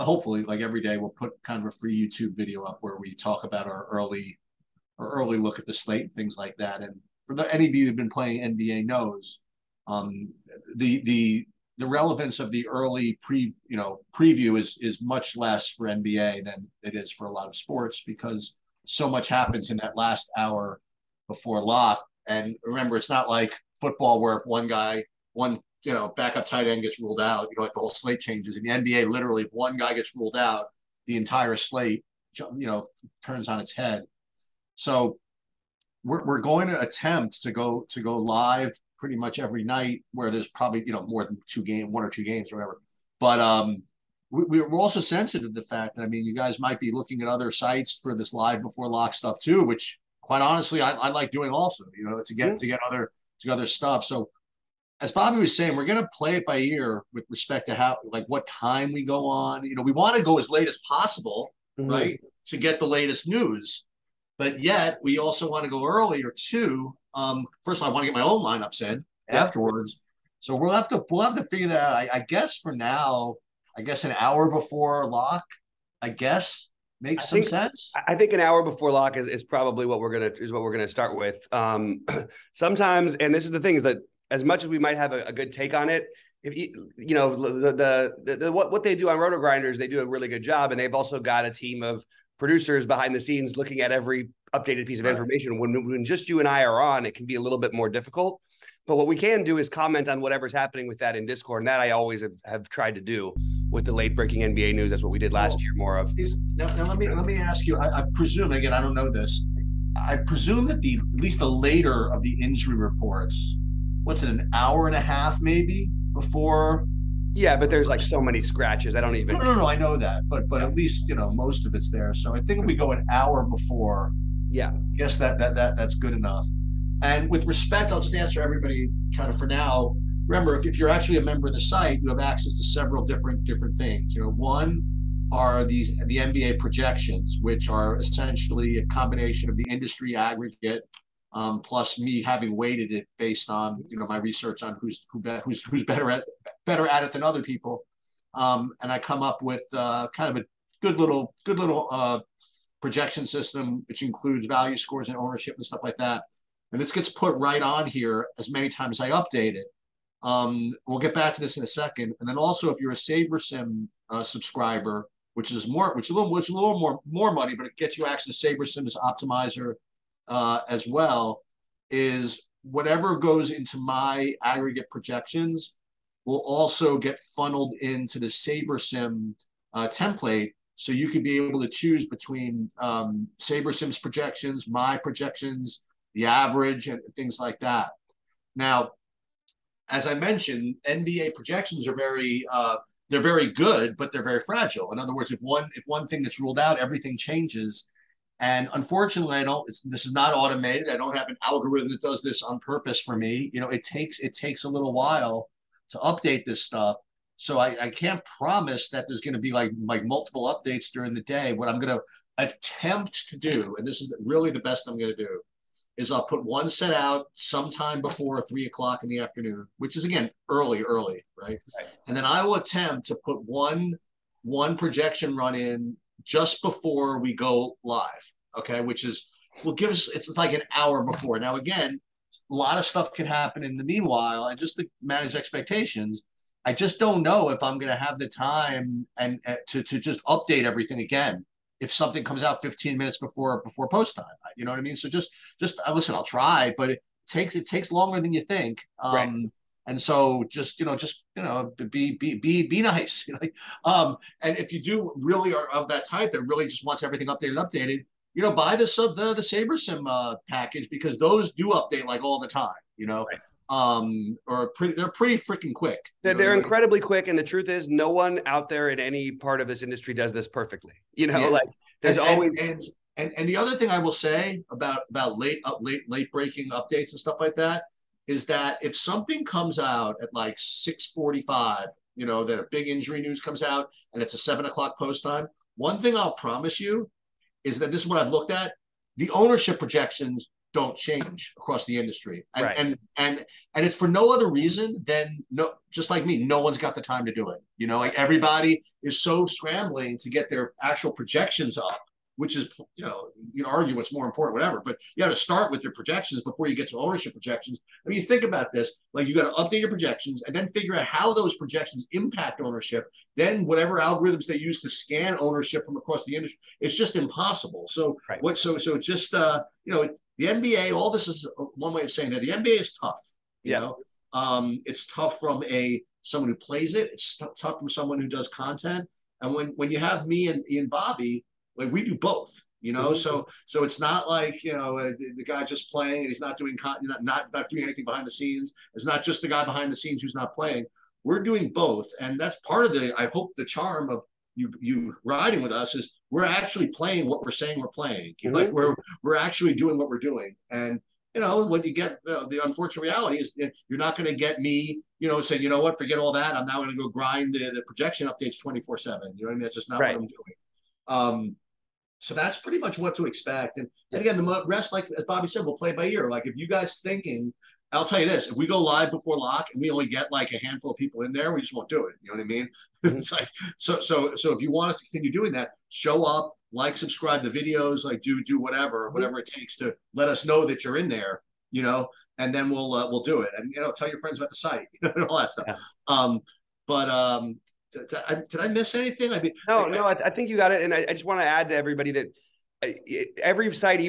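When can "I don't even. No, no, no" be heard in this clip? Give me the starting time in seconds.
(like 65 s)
118 s.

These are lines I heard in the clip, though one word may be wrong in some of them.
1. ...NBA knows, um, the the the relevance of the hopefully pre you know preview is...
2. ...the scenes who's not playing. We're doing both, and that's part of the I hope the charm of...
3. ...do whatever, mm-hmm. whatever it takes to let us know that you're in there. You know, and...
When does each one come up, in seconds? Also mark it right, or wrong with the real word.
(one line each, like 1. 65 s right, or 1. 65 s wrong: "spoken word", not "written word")
1. 8 s wrong: "early", not "hopefully"
2. 339 s right
3. 378 s right.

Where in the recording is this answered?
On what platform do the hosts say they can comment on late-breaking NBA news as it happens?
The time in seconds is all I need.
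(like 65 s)
101 s.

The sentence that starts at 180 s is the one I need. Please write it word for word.
So you could be able to choose between um, SaberSim's projections, my projections, the average, and things like that.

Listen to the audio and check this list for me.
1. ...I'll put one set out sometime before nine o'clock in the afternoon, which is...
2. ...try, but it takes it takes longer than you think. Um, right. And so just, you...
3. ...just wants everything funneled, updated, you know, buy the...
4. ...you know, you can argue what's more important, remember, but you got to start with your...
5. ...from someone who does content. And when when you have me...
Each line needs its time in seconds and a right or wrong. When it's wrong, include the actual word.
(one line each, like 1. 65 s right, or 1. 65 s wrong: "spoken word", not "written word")
1. 216 s wrong: "three", not "nine"
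2. 246 s right
3. 256 s wrong: "updated", not "funneled"
4. 302 s wrong: "whatever", not "remember"
5. 327 s right.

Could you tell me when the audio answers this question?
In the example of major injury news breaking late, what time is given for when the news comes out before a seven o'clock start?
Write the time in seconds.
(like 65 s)
280 s.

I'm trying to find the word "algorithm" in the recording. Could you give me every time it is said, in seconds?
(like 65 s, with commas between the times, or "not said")
201 s, 313 s.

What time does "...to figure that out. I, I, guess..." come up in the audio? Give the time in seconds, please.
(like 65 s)
71 s.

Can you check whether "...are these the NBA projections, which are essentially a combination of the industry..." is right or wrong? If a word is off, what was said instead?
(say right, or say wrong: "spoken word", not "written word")
right.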